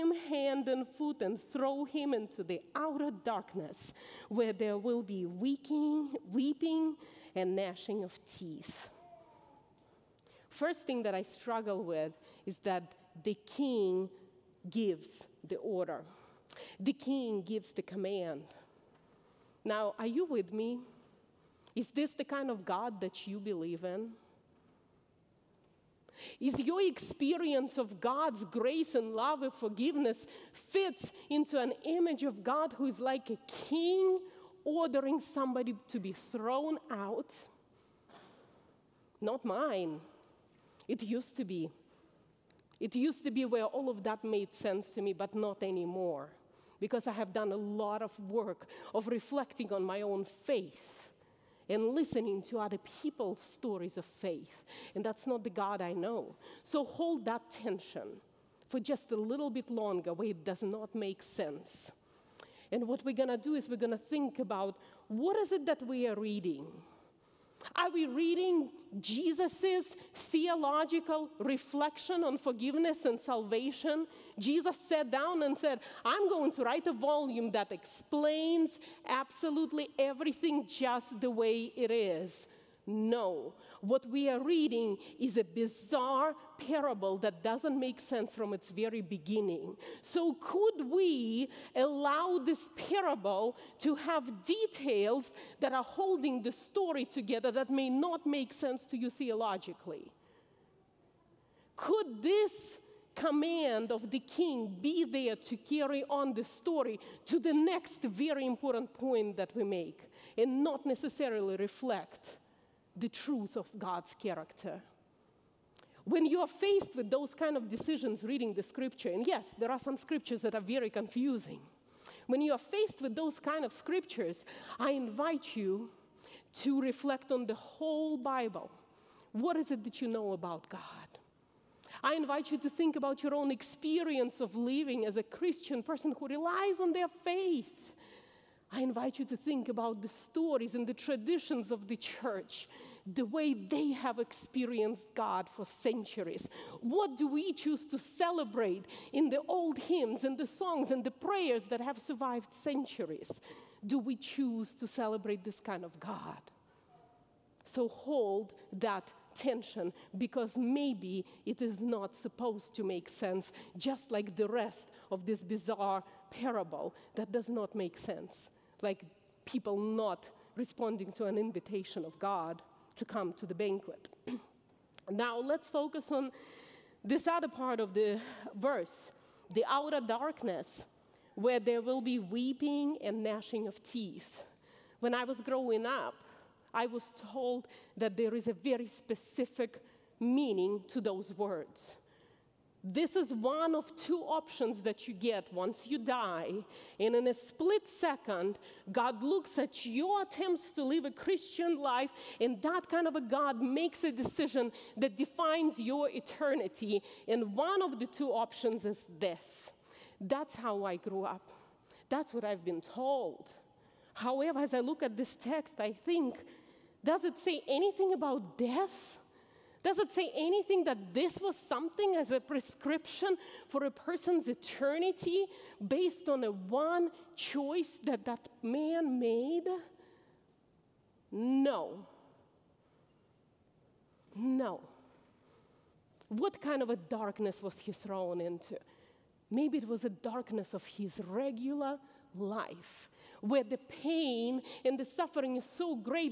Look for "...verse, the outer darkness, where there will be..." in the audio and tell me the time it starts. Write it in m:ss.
2:58.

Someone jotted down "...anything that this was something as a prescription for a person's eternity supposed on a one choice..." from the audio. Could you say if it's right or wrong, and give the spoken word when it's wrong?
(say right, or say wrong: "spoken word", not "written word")
wrong: "based", not "supposed".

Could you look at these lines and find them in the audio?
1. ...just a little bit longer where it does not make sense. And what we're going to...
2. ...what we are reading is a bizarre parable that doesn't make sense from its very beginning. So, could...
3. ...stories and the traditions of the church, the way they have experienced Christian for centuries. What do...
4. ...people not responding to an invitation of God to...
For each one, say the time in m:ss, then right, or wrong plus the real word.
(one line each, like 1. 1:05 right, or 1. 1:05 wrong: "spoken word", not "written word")
1. 0:58 right
2. 1:23 right
3. 2:20 wrong: "God", not "Christian"
4. 2:49 right.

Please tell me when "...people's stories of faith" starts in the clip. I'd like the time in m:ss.
0:53.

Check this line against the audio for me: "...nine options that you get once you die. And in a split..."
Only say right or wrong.
wrong.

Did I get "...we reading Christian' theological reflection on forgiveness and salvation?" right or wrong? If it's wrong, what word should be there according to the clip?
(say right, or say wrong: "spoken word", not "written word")
wrong: "Jesus", not "Christian".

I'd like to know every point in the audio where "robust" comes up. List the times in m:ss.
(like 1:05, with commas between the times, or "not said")
not said.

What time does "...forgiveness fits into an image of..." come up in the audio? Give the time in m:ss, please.
0:29.